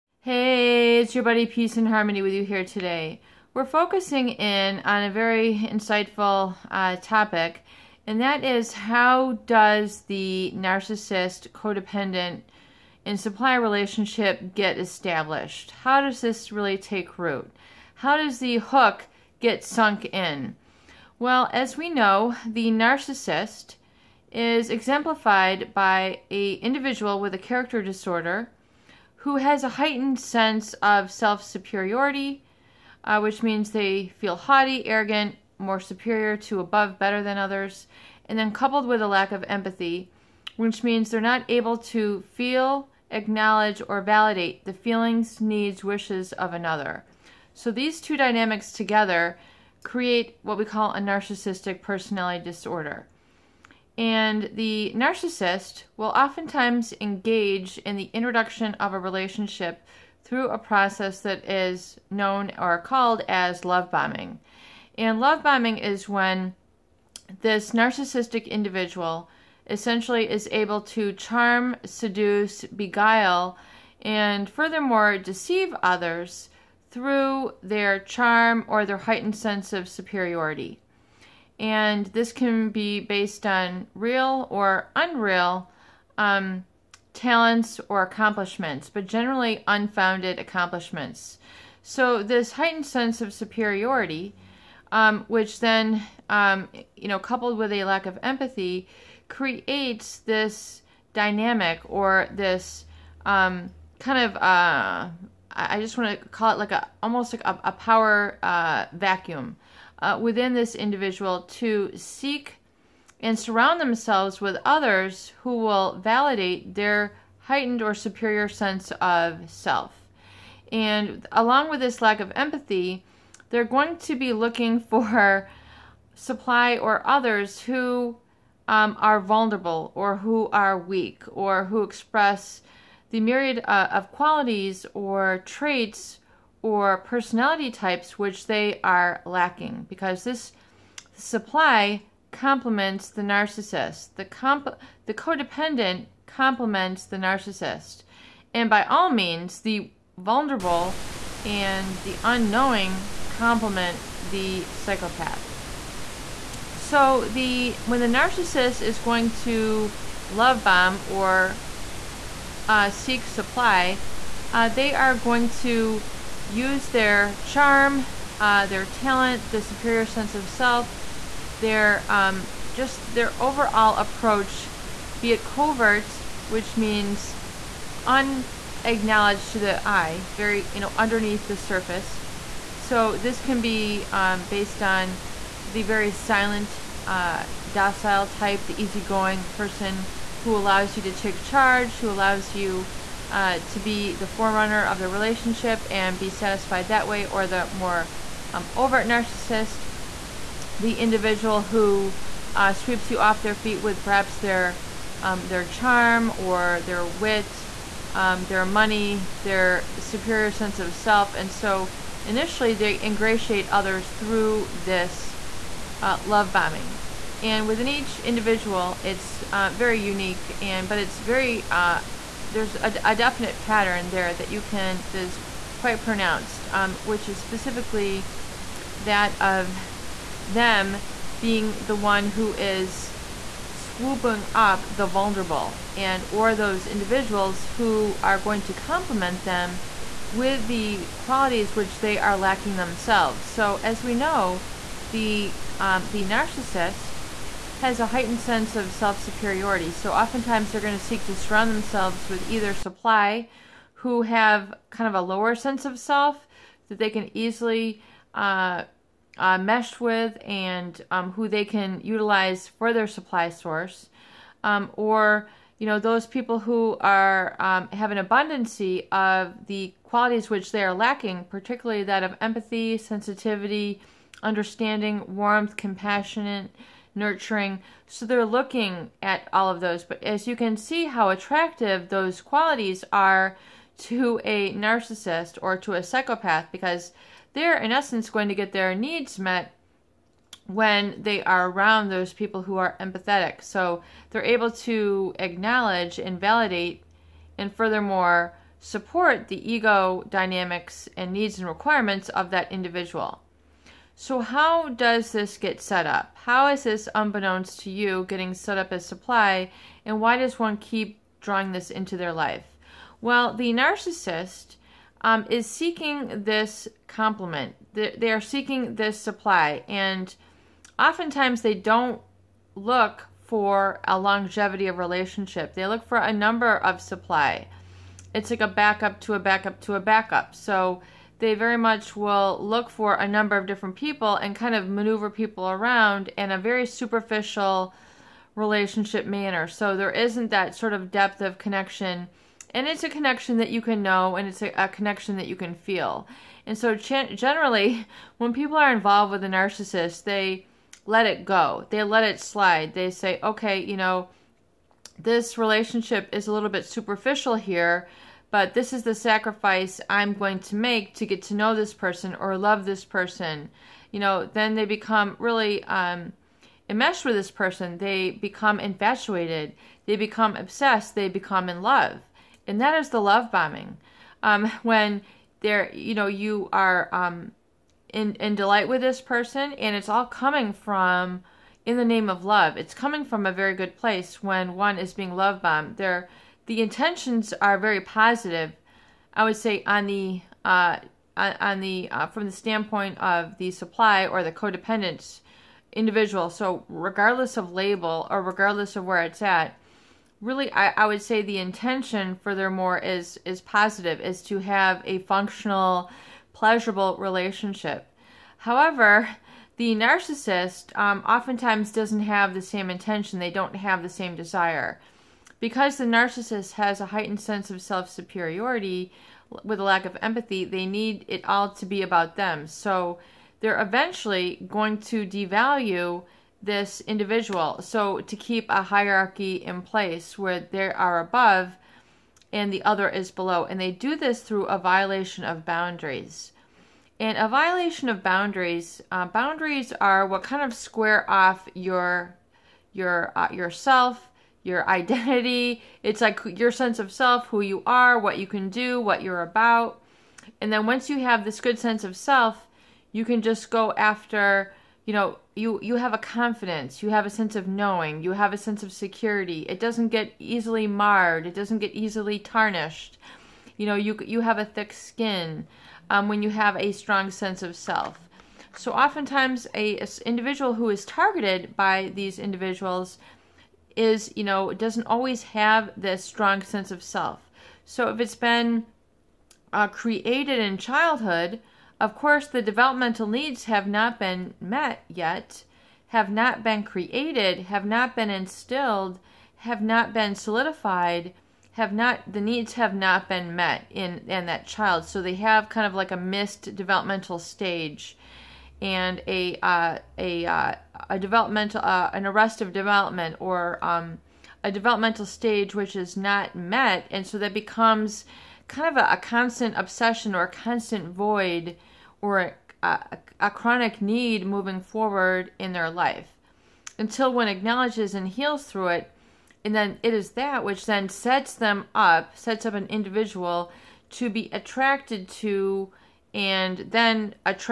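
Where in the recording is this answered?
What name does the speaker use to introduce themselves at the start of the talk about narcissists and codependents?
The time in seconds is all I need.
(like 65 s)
1 s.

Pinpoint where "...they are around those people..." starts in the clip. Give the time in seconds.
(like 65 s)
291 s.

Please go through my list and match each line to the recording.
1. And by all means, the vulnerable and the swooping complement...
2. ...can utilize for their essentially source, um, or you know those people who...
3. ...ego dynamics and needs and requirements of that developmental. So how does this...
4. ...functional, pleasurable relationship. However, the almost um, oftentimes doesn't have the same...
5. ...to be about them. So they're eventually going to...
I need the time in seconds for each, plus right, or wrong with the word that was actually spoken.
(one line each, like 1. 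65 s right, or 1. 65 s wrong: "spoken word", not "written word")
1. 148 s wrong: "unknowing", not "swooping"
2. 261 s wrong: "supply", not "essentially"
3. 299 s wrong: "individual", not "developmental"
4. 405 s wrong: "narcissist", not "almost"
5. 421 s right.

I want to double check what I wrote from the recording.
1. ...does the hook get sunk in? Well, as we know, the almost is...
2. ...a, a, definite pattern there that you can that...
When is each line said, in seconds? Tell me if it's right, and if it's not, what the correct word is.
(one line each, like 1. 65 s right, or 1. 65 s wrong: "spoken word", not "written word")
1. 18 s wrong: "narcissist", not "almost"
2. 222 s right.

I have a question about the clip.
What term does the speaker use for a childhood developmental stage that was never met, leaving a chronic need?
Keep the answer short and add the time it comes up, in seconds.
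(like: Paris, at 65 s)
Arrest of development, at 502 s.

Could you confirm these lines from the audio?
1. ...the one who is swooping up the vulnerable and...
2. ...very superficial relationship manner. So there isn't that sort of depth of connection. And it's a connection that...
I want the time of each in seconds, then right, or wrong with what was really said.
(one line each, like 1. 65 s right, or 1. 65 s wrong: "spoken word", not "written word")
1. 231 s right
2. 336 s right.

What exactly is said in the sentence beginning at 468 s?
So oftentimes, a, a individual who is targeted by these individuals is, you know, doesn't always have this strong sense of self.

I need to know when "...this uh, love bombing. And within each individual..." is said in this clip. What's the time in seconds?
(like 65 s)
214 s.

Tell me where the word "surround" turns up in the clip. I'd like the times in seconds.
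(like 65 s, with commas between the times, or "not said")
113 s, 251 s.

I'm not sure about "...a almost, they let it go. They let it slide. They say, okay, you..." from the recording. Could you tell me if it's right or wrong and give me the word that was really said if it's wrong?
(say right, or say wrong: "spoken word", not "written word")
wrong: "narcissist", not "almost".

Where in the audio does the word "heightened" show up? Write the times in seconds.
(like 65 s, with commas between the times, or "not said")
29 s, 78 s, 92 s, 117 s, 248 s, 417 s.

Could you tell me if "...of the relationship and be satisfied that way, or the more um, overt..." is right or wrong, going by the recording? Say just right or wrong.
right.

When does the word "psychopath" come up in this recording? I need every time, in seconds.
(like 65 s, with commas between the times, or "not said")
154 s, 286 s.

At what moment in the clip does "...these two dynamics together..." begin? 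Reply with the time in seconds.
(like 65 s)
47 s.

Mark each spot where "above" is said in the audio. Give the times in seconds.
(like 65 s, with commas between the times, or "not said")
36 s, 431 s.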